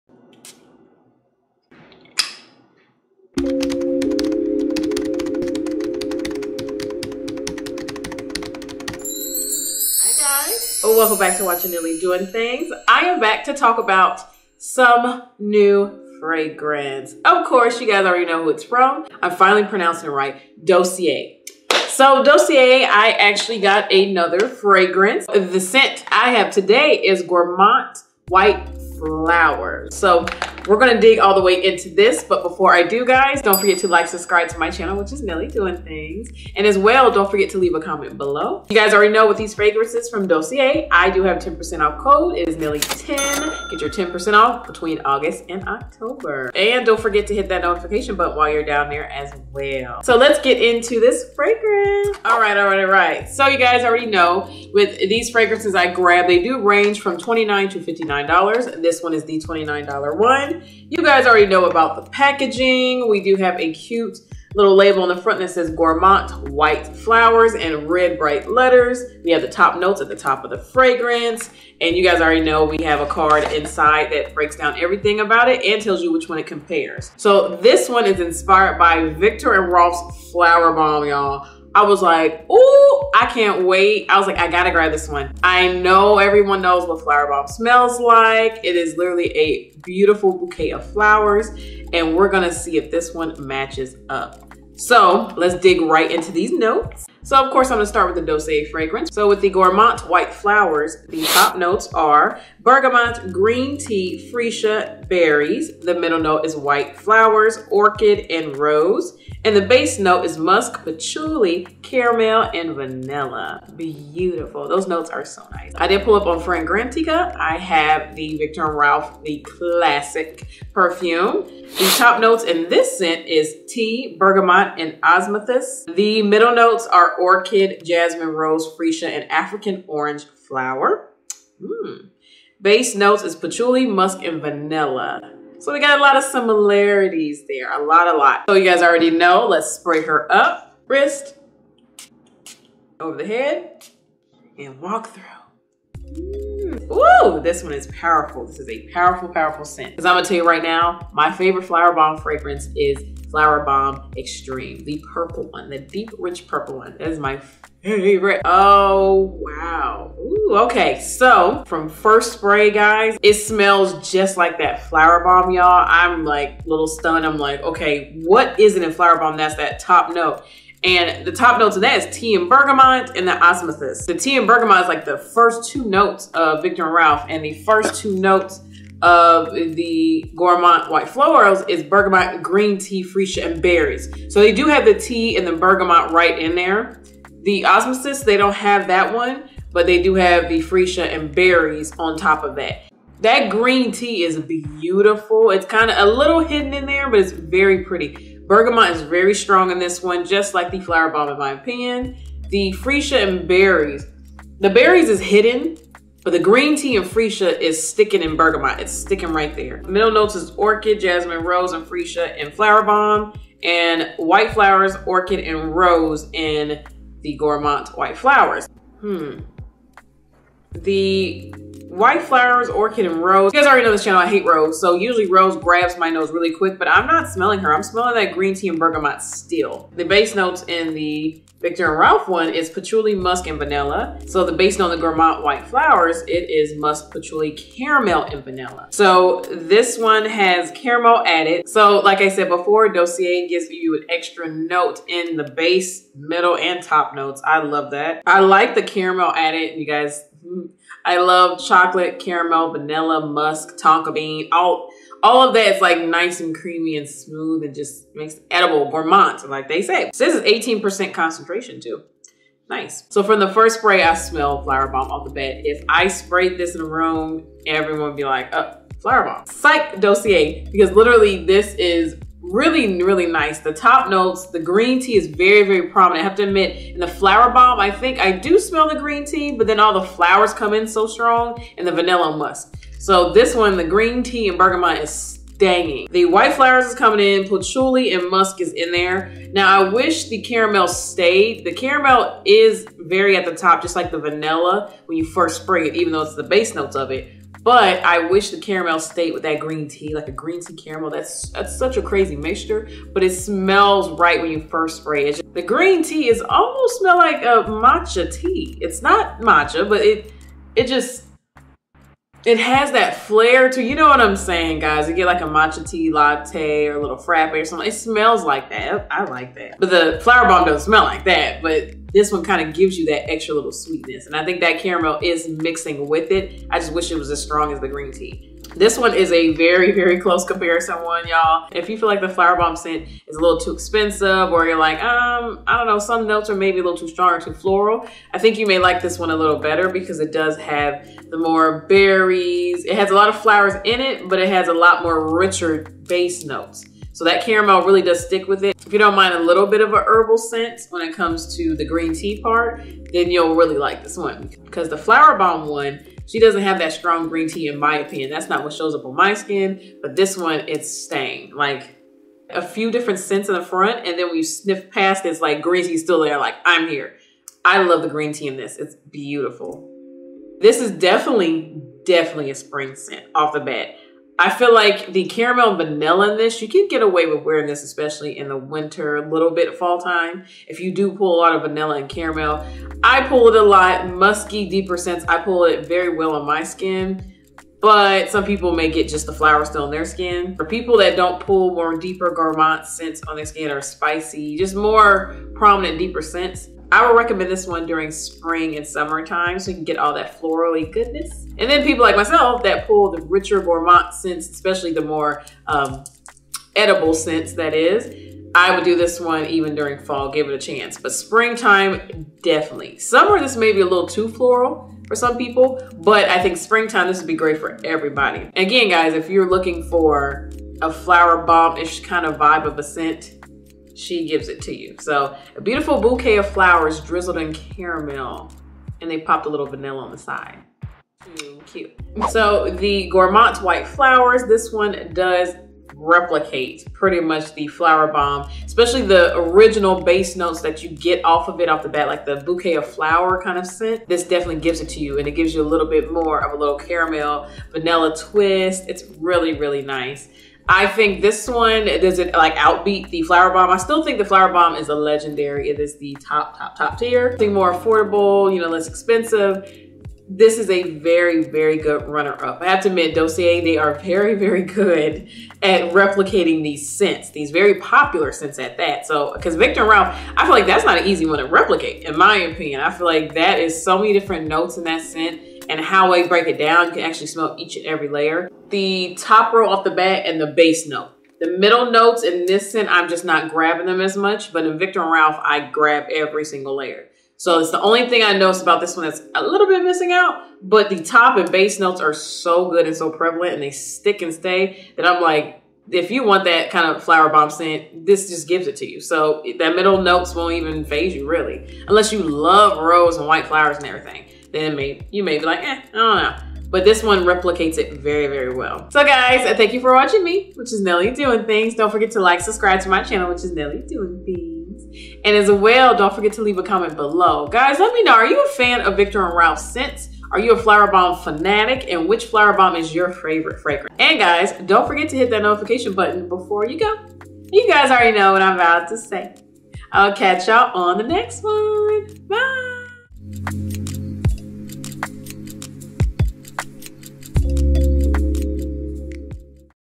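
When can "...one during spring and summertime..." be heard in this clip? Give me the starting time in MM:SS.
06:37.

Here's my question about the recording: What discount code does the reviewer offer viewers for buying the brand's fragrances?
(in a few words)
Nelle10.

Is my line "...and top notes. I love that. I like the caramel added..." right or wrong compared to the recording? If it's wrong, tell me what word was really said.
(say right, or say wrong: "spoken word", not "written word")
right.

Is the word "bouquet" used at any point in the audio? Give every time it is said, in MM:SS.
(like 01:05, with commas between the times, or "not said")
01:30, 07:05, 07:22.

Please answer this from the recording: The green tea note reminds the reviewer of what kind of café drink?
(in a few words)
Matcha tea latte.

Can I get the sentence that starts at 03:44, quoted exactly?
So usually rose grabs my nose really quick, but I'm not smelling her.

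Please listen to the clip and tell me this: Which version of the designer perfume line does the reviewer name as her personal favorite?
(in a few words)
Flowerbomb Extreme.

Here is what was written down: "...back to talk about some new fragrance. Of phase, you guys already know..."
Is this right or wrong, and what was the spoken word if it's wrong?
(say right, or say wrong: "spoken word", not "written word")
wrong: "course", not "phase".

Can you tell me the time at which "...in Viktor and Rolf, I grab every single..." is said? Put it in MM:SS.
08:04.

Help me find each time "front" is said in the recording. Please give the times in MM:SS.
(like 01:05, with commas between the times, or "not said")
01:05, 06:03.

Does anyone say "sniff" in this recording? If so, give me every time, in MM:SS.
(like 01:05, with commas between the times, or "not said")
06:04.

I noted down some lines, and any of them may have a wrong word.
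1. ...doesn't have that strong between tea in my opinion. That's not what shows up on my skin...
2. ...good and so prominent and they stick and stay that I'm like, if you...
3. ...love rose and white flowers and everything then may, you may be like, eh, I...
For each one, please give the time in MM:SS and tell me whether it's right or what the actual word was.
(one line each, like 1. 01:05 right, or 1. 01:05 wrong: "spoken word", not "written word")
1. 05:56 wrong: "green", not "between"
2. 08:12 wrong: "prevalent", not "prominent"
3. 08:22 right.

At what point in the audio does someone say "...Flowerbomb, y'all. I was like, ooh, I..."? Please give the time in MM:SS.
01:20.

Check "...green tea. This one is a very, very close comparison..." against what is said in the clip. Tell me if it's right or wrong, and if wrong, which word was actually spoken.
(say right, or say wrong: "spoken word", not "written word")
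right.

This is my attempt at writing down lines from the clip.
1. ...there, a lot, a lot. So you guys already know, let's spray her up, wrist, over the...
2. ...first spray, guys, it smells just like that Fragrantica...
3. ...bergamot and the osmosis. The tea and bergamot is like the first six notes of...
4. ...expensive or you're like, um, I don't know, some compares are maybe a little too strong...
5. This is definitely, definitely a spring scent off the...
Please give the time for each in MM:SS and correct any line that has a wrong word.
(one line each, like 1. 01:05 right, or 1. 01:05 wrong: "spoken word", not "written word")
1. 02:17 right
2. 02:41 wrong: "Flowerbomb", not "Fragrantica"
3. 02:52 wrong: "two", not "six"
4. 05:33 wrong: "notes", not "compares"
5. 06:10 right.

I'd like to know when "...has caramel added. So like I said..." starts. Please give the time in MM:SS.
04:00.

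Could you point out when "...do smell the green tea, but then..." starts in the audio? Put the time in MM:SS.
04:38.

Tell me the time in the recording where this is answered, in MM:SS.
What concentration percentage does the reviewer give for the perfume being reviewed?
04:20.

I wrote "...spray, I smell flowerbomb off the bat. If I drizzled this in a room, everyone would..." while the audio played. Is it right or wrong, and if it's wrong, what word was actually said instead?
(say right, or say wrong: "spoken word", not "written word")
wrong: "sprayed", not "drizzled".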